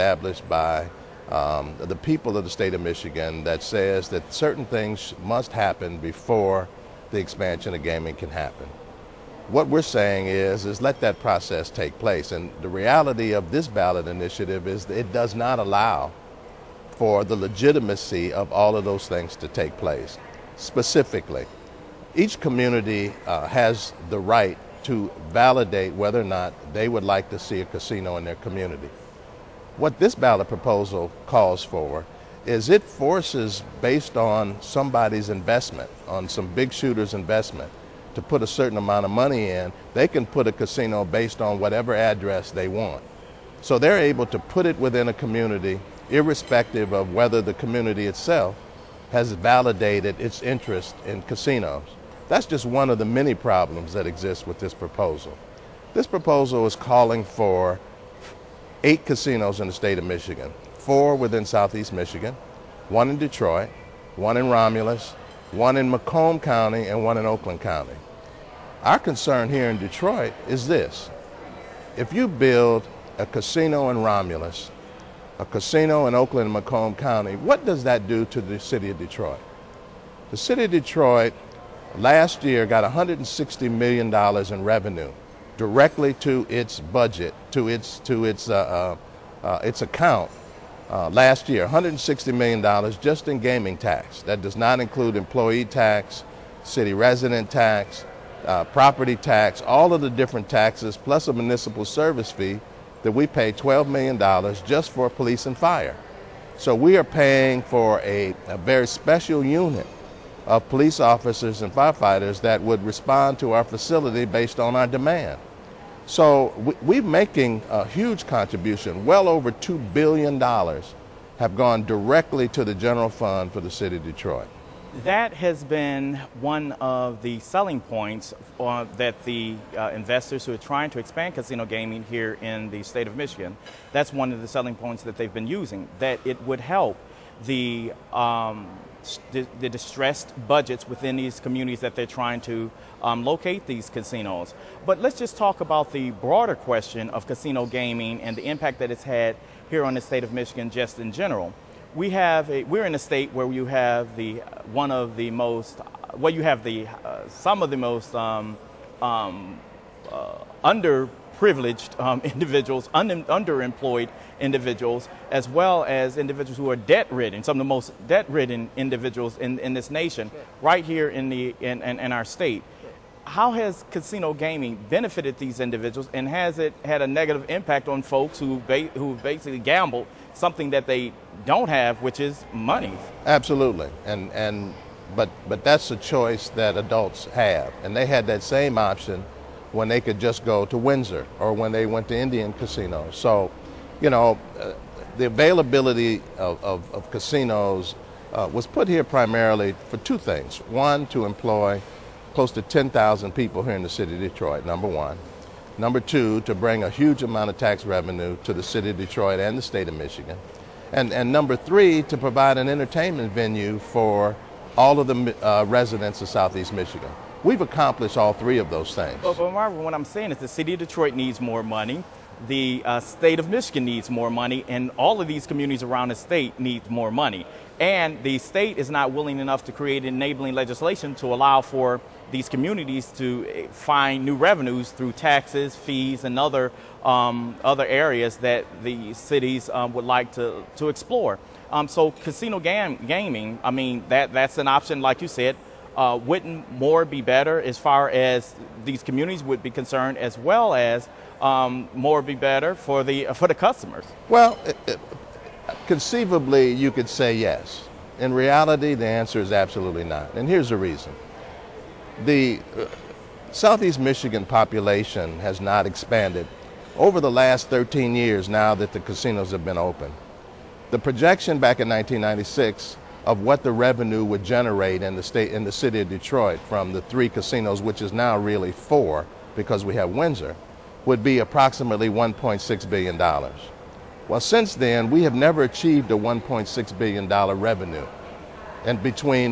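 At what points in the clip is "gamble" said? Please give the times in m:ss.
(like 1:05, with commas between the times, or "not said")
2:59.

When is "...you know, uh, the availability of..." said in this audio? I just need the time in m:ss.
3:13.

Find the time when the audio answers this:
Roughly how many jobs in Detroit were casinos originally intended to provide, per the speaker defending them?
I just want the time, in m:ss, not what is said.
3:22.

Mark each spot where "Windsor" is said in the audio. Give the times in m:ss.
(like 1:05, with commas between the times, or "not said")
3:10, 4:40.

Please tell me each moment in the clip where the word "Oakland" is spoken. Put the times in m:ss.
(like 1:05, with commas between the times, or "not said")
1:07, 1:16.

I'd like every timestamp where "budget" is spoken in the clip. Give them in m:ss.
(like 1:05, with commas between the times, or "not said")
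1:26, 2:20.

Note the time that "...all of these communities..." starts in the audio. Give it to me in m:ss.
3:44.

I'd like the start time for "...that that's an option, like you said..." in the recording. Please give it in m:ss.
4:04.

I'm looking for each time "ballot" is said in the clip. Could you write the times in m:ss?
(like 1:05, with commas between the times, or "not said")
0:13, 0:30.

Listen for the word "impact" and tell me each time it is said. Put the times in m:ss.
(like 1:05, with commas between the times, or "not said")
2:28, 2:57.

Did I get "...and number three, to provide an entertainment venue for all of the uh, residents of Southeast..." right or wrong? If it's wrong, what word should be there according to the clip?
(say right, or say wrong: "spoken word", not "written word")
right.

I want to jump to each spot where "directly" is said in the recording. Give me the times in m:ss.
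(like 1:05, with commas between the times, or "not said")
1:25, 2:01.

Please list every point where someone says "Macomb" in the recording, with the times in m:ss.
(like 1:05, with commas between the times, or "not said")
1:05, 1:16.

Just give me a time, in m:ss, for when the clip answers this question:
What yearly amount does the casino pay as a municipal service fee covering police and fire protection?
1:43.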